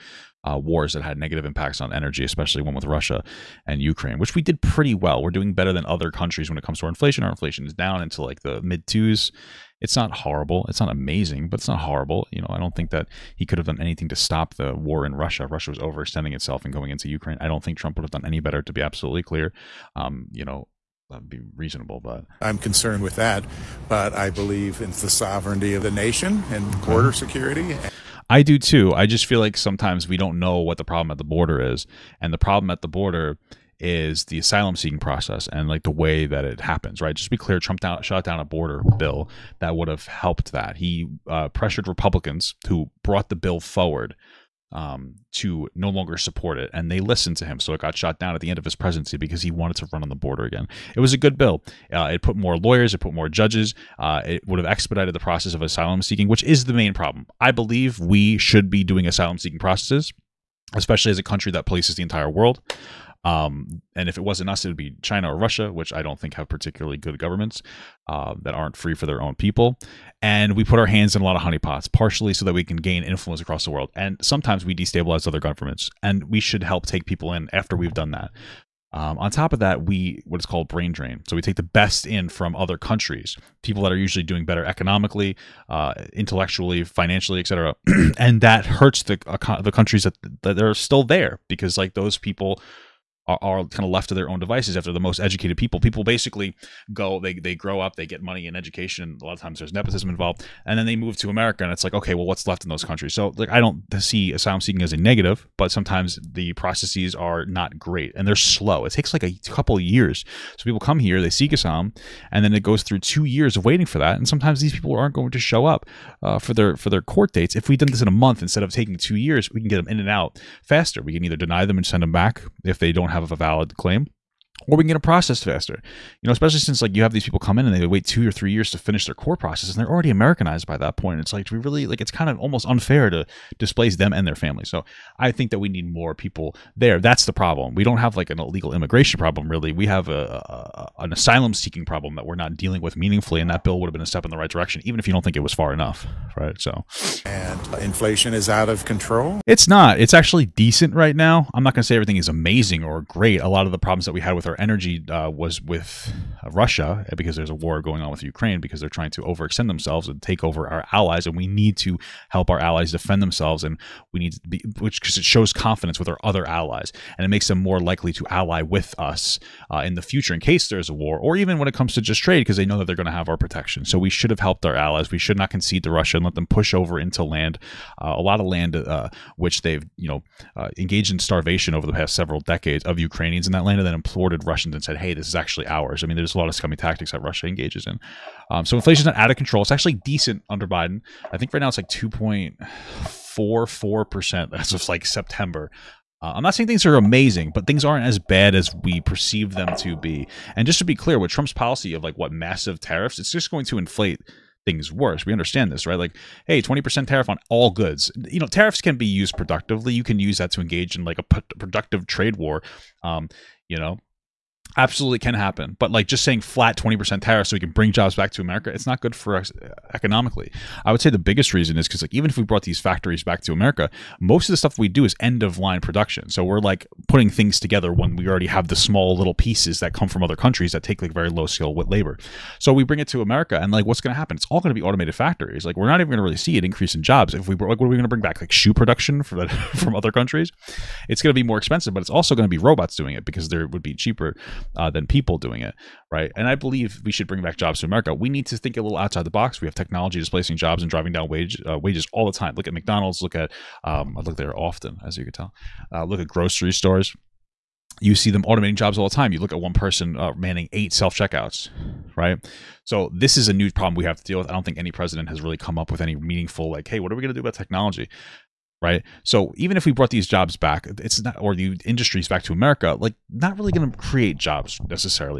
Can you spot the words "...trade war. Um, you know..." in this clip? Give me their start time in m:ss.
3:32.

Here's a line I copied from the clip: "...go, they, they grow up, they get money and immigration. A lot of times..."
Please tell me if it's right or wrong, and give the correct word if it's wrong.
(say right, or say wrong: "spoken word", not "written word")
wrong: "education", not "immigration".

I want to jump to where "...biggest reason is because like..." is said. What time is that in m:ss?
3:41.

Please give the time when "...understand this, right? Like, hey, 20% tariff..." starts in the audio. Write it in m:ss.
3:25.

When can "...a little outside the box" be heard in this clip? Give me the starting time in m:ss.
4:08.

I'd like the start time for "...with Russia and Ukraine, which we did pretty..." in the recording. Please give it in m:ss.
0:02.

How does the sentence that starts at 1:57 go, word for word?
If we did this in a month instead of taking two years, we can get them in and out faster.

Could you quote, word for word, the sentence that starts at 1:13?
And sometimes we destabilize other governments, and we should help take people in after we've done that.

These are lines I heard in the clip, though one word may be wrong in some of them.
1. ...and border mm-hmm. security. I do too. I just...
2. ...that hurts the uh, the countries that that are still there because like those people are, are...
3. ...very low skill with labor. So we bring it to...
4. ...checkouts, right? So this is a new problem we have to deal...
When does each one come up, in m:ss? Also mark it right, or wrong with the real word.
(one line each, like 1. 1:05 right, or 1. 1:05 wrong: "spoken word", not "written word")
1. 0:26 right
2. 1:28 right
3. 3:51 right
4. 4:21 right.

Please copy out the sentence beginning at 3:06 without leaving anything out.
I mean, there's a lot of scummy tactics that Russia engages in.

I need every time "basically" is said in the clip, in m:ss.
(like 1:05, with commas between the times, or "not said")
1:36.